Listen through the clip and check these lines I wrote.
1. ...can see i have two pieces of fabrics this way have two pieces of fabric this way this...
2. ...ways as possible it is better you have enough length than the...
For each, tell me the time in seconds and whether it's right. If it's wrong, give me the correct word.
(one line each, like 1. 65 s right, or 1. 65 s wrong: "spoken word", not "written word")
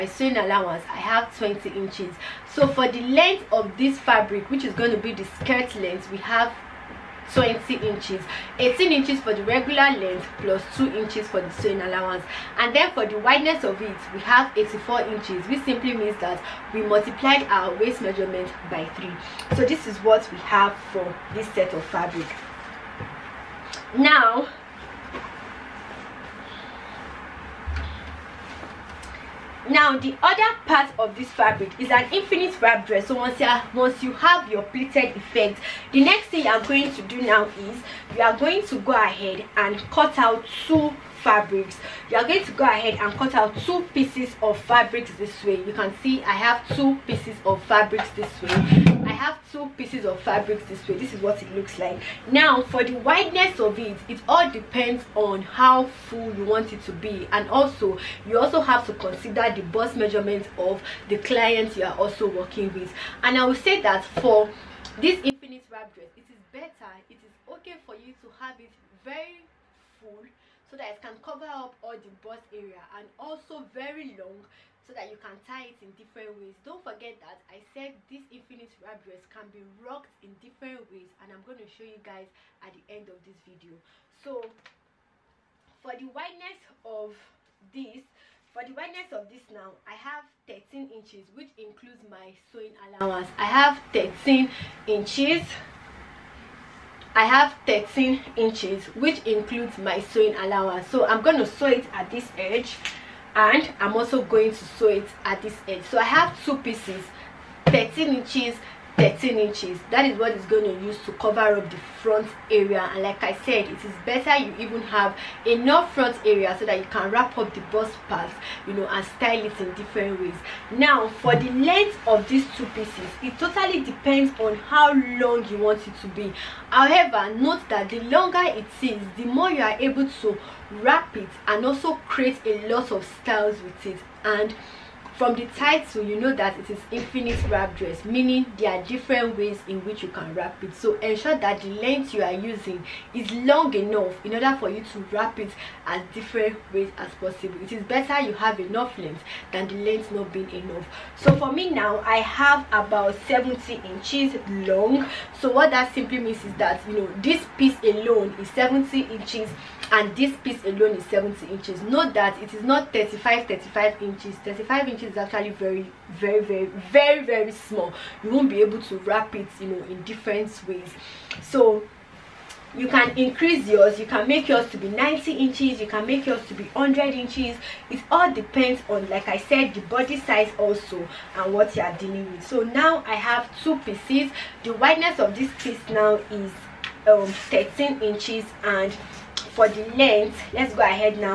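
1. 45 s right
2. 146 s right.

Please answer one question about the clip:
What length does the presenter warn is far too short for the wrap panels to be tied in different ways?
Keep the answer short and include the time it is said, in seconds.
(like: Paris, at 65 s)
35 inches, at 164 s.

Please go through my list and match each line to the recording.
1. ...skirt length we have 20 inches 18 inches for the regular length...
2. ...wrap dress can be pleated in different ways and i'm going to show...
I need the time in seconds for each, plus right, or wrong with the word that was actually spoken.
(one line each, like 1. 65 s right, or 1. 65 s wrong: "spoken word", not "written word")
1. 5 s right
2. 78 s wrong: "rocked", not "pleated".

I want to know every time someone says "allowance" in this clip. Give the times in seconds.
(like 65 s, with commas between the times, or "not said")
0 s, 11 s, 92 s, 100 s.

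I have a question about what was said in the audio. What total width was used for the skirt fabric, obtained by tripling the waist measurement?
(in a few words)
84 inches.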